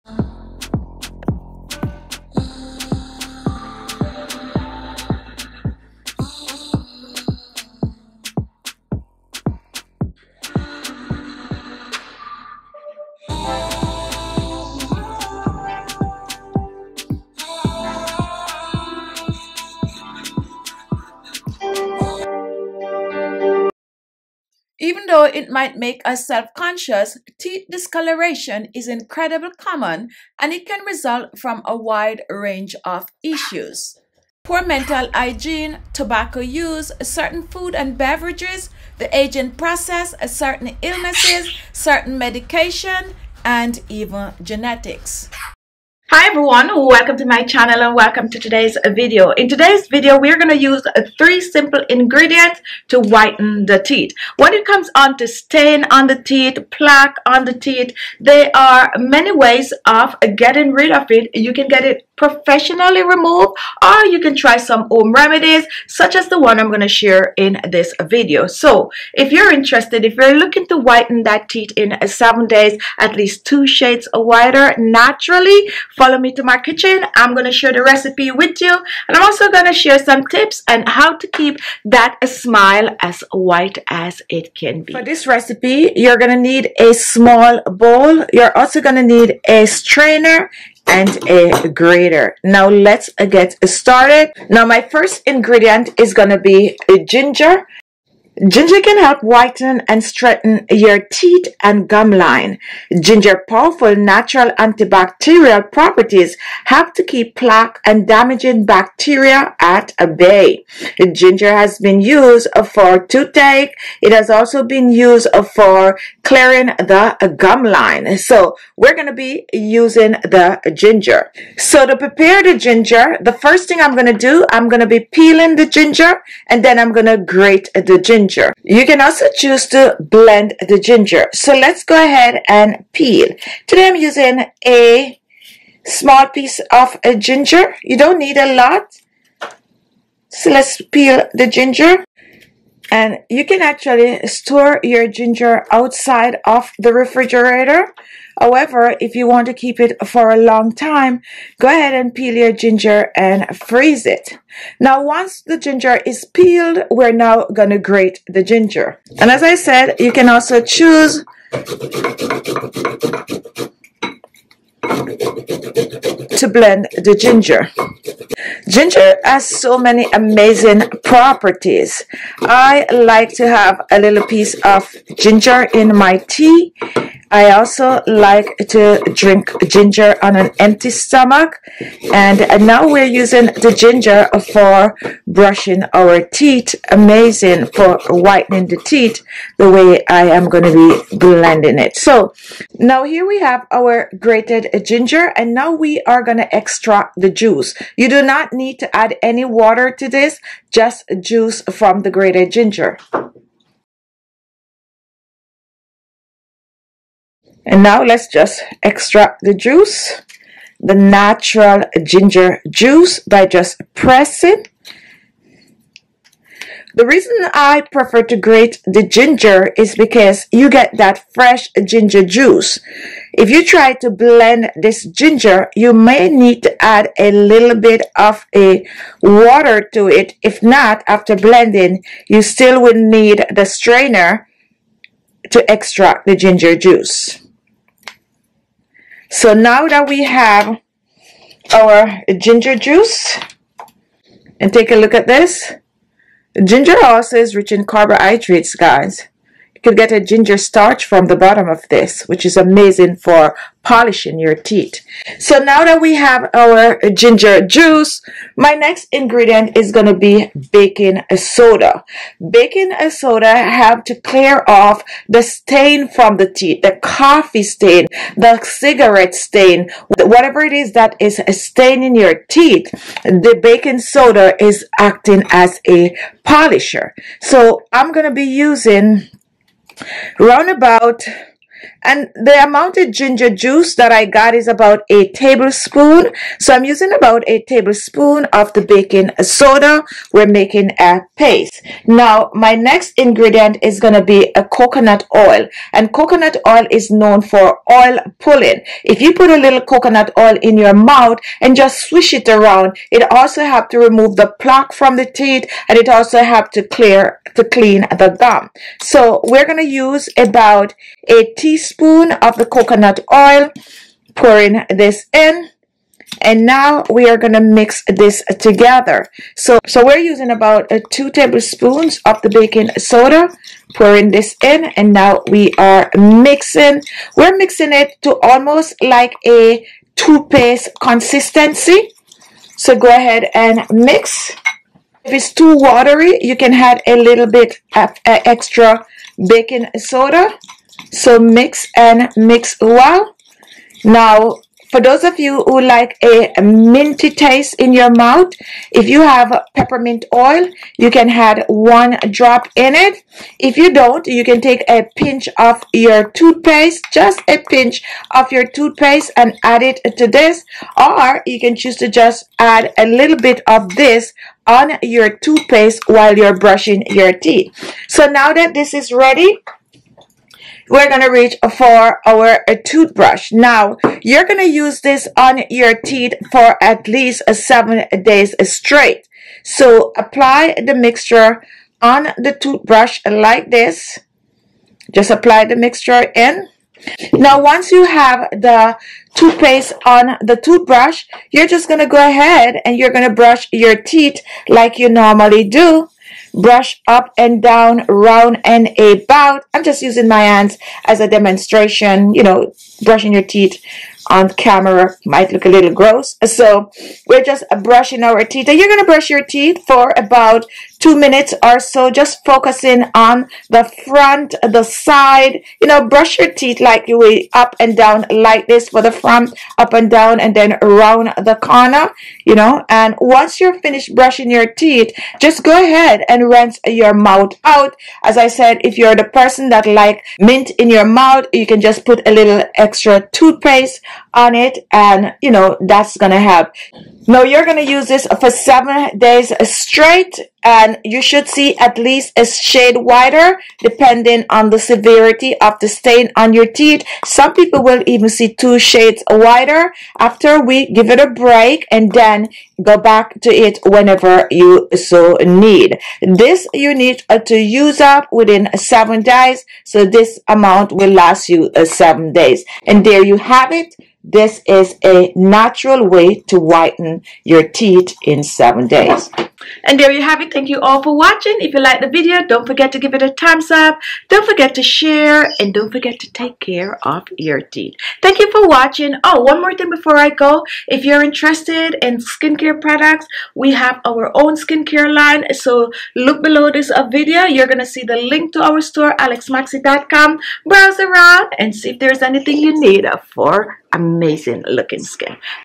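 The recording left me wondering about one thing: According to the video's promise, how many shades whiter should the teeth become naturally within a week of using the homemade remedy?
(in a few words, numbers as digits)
2.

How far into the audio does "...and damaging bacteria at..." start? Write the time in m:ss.
1:47.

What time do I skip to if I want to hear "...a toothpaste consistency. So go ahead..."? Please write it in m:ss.
5:29.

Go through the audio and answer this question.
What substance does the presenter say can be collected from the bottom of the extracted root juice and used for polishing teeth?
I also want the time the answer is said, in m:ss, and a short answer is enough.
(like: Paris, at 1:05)
ginger starch, at 4:10.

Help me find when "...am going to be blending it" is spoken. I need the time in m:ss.
3:10.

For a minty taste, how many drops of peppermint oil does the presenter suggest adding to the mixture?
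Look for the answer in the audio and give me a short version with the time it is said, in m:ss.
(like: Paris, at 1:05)
1, at 5:51.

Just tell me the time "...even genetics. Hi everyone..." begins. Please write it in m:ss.
0:43.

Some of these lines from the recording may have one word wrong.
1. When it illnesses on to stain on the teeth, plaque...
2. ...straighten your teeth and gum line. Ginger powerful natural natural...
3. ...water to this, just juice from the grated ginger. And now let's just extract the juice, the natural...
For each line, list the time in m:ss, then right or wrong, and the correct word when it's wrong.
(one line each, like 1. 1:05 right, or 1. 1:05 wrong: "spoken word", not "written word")
1. 0:54 wrong: "comes", not "illnesses"
2. 1:40 wrong: "antibacterial", not "natural"
3. 3:19 right.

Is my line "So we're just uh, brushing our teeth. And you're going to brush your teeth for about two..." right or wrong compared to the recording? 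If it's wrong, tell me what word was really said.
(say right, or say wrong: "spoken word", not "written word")
right.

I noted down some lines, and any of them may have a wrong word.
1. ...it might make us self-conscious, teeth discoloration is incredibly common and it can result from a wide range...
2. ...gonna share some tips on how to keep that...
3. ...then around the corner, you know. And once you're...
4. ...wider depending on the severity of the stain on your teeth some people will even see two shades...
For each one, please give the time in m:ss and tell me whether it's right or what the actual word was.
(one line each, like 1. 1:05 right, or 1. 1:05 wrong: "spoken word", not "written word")
1. 0:25 right
2. 1:19 right
3. 7:00 right
4. 7:22 right.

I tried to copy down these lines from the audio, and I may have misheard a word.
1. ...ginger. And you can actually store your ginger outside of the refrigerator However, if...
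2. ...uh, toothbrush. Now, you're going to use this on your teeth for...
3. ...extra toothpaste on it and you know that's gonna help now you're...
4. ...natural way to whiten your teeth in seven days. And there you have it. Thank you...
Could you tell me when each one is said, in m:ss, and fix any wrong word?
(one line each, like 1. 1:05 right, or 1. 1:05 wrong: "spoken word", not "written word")
1. 2:21 right
2. 6:12 right
3. 7:12 right
4. 7:45 right.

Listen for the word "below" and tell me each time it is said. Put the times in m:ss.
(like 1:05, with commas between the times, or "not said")
8:06.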